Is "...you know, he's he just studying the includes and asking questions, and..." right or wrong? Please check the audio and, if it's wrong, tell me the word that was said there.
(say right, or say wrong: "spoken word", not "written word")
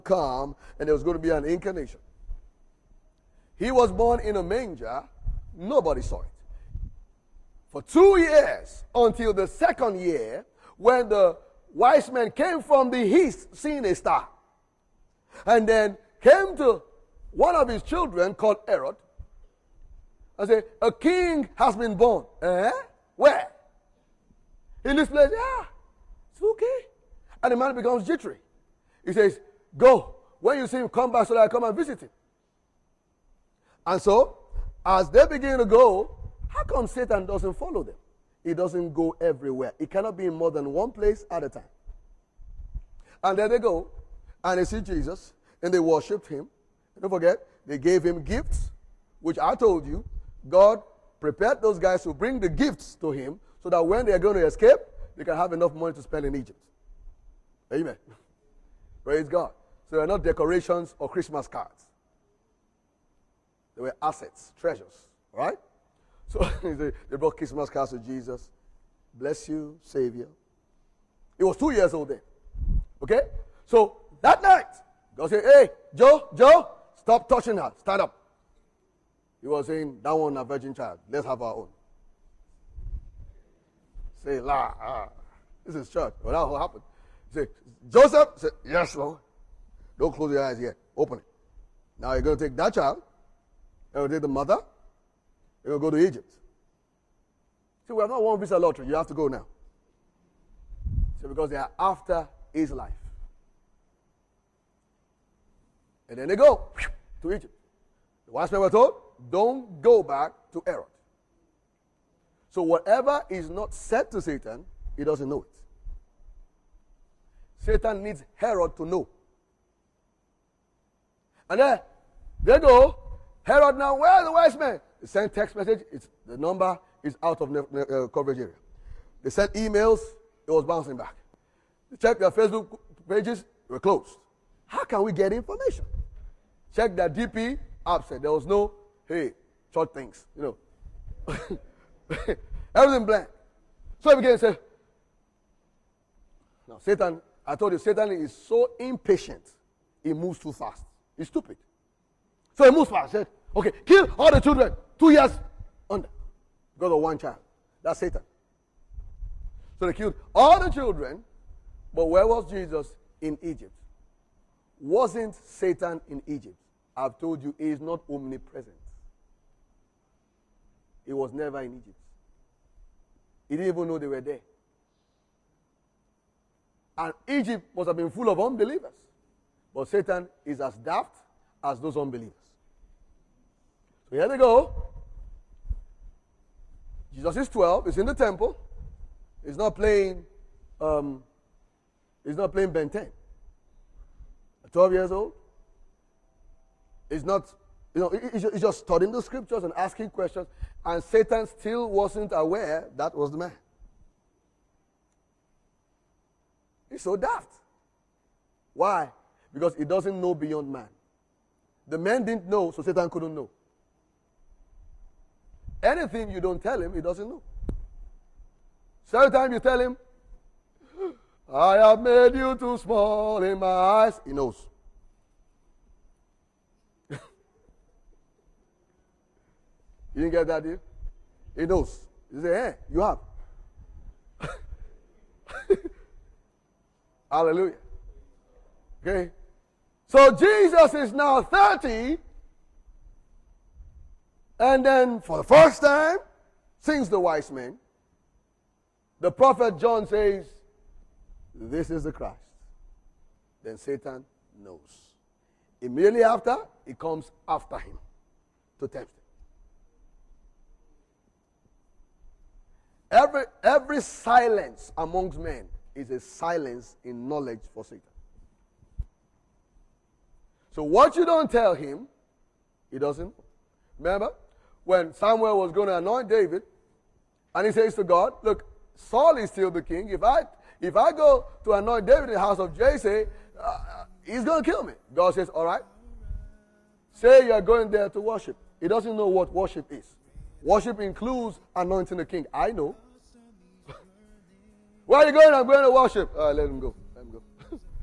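wrong: "scriptures", not "includes".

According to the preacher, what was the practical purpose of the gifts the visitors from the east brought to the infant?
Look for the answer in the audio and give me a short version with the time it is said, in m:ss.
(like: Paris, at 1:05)
Money to spend in Egypt, at 0:55.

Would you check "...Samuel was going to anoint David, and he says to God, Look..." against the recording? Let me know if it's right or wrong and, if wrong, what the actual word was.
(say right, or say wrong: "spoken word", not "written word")
right.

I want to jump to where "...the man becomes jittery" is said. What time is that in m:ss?
0:27.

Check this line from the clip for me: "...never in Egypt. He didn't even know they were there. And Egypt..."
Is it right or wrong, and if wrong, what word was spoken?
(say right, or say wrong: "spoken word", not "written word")
right.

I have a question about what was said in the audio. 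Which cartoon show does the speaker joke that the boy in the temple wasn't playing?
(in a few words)
Ben 10.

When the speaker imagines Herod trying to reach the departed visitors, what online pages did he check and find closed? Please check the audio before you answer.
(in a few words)
Facebook pages.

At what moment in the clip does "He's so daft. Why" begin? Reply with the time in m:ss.
3:26.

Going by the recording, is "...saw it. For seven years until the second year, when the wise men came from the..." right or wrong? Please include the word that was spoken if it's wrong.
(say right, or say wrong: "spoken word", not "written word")
wrong: "two", not "seven".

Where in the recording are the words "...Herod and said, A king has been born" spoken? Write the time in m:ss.
0:18.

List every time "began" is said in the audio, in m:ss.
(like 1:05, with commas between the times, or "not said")
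2:24.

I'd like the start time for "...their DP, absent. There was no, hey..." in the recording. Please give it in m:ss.
2:16.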